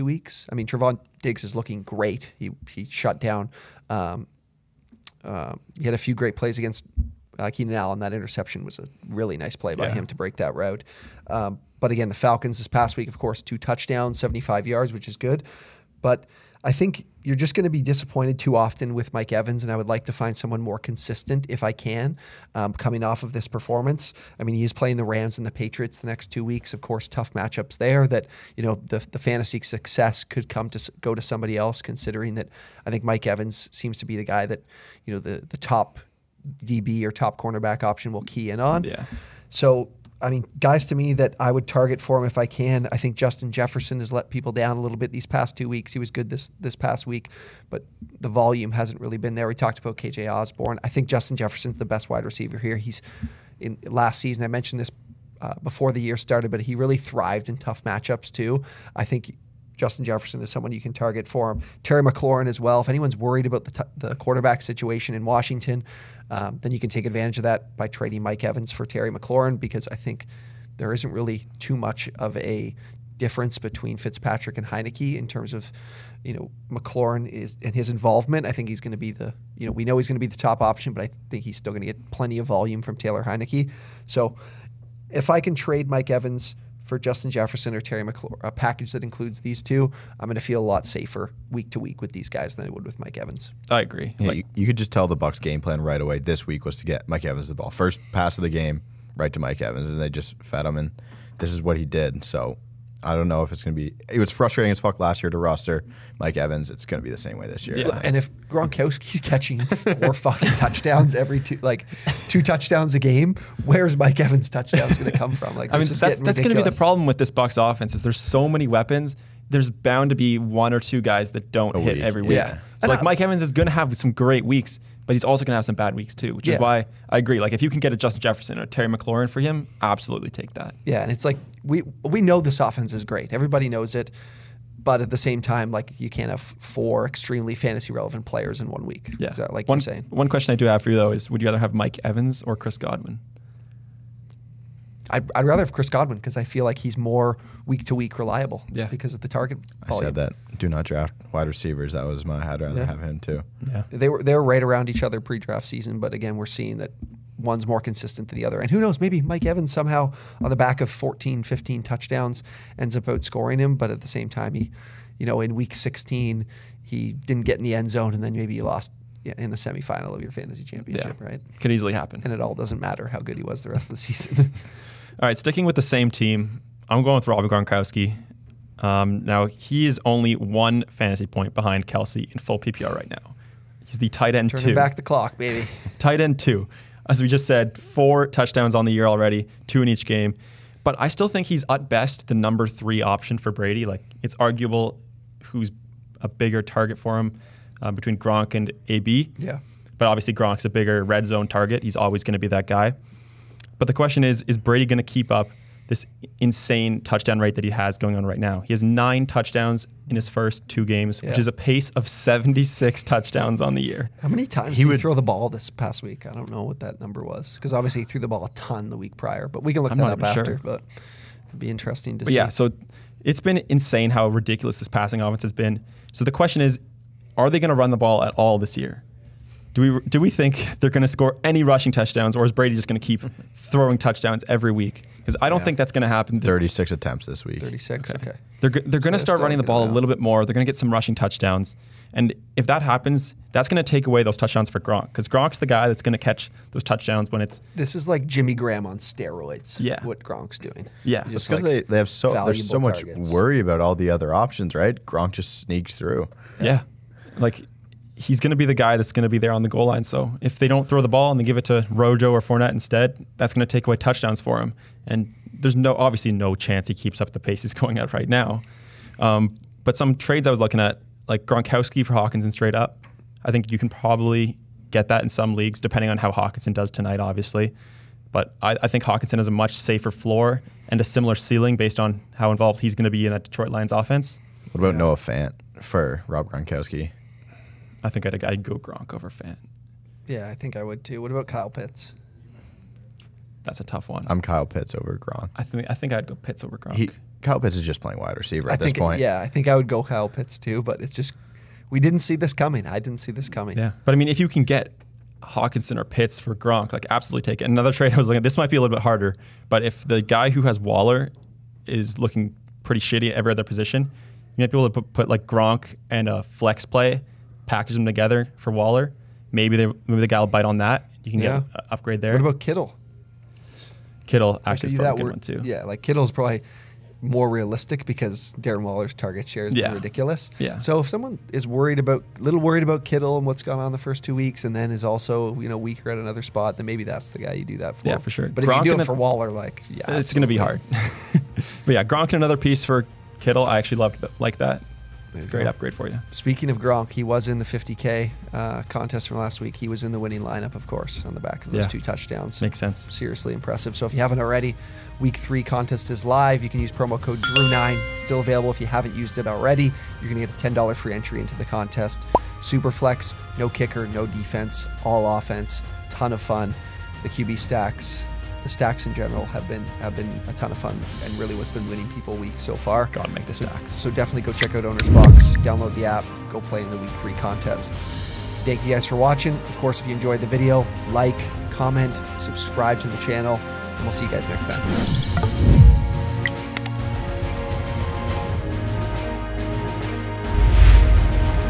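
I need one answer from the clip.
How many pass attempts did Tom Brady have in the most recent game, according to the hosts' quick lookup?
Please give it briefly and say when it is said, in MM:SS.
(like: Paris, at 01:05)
36, at 03:56.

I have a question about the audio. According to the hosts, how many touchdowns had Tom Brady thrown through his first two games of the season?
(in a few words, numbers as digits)
9.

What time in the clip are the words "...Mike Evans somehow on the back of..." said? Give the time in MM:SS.
02:39.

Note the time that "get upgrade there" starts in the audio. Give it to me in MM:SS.
05:21.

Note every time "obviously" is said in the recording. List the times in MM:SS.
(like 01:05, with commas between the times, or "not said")
03:20, 03:37, 04:25, 04:37.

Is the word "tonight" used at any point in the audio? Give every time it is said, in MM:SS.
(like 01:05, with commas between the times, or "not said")
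04:36.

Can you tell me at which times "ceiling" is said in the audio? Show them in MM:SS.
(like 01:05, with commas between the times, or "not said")
04:41.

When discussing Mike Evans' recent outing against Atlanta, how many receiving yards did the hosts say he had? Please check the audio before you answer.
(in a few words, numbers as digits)
75.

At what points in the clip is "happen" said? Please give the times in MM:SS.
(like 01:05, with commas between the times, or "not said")
02:51, 03:56, 04:02.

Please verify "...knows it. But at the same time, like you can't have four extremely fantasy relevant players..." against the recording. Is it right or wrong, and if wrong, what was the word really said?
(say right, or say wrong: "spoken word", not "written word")
right.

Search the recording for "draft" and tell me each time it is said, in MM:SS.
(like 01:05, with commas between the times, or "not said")
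02:30, 02:35.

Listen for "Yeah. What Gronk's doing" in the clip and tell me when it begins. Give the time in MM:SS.
04:09.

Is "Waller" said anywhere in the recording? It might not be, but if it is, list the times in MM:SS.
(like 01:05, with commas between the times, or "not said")
05:10, 05:18, 05:28, 05:39.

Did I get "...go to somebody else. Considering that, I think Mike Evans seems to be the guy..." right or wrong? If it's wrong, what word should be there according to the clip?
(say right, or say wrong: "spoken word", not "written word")
right.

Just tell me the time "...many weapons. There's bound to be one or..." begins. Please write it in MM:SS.
01:58.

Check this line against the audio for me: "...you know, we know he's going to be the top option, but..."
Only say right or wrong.
right.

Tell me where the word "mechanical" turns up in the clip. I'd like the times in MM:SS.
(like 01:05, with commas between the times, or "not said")
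not said.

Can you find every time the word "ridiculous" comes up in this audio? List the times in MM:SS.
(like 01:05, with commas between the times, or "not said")
03:44, 05:29.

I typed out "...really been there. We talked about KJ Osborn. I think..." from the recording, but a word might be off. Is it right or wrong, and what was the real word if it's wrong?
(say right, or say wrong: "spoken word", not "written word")
right.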